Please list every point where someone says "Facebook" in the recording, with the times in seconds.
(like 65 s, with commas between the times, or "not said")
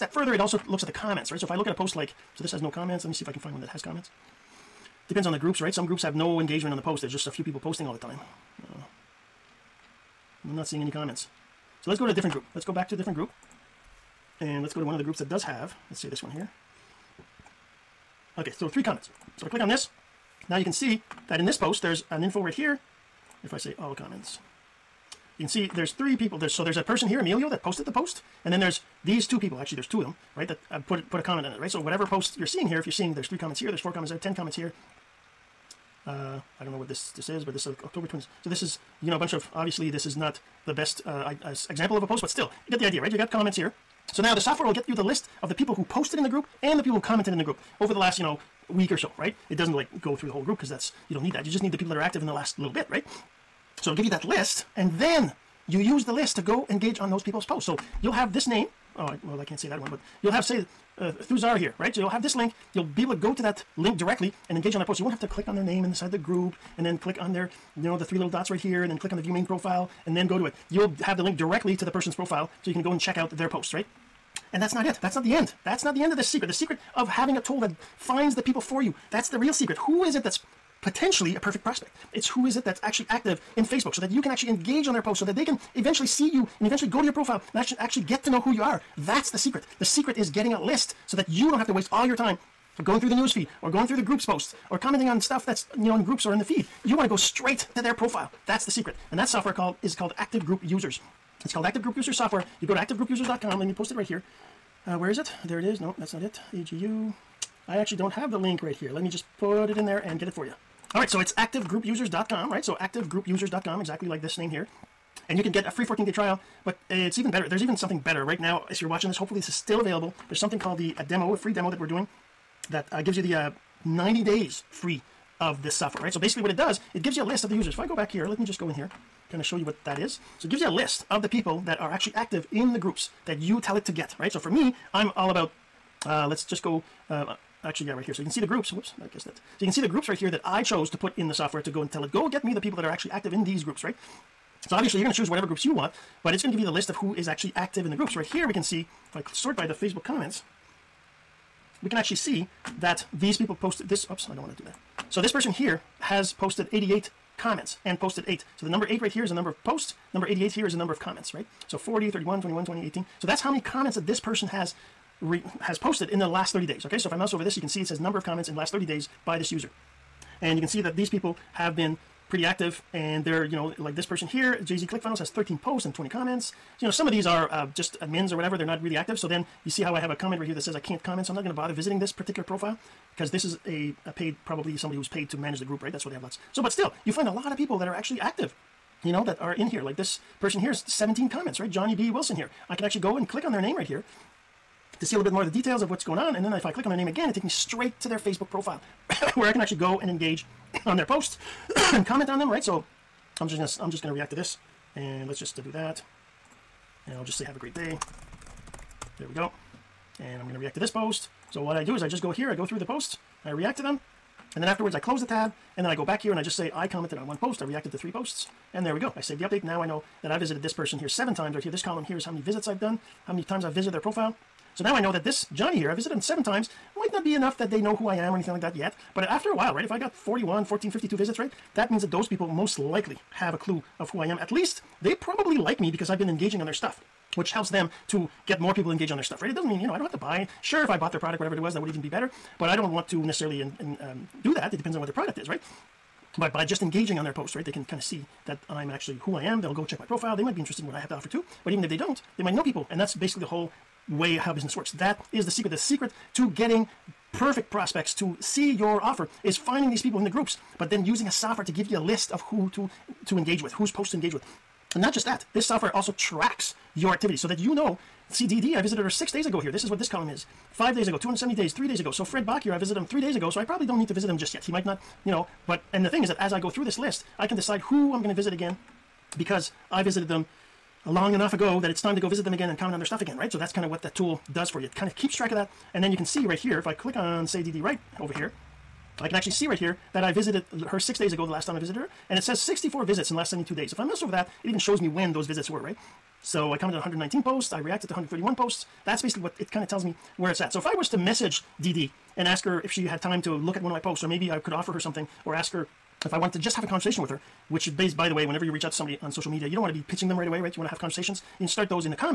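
83 s, 149 s, 198 s.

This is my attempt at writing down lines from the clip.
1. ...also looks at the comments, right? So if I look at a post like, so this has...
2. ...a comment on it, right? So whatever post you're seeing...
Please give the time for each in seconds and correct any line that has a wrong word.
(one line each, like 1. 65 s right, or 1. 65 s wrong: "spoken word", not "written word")
1. 0 s right
2. 31 s right.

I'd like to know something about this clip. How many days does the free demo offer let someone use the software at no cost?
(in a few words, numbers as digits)
90 days.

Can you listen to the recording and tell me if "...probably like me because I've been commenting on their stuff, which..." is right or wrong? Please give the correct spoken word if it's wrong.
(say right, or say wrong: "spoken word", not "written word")
wrong: "engaging", not "commenting".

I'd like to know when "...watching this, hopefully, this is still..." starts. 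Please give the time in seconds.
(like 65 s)
118 s.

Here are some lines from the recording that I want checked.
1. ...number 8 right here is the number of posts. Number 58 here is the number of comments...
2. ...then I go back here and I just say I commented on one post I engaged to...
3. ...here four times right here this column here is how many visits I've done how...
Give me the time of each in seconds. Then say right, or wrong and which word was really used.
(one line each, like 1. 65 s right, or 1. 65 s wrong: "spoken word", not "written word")
1. 158 s wrong: "88", not "58"
2. 215 s wrong: "reacted", not "engaged"
3. 220 s wrong: "seven", not "four".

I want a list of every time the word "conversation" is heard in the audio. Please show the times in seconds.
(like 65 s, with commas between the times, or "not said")
306 s, 310 s.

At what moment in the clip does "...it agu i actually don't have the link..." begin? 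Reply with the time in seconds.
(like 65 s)
106 s.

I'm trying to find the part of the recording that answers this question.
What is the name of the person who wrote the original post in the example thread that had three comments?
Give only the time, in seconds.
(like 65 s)
27 s.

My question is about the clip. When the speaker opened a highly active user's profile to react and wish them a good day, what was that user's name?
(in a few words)
Johnny B. Wilson.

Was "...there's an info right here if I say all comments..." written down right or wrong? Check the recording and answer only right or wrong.
right.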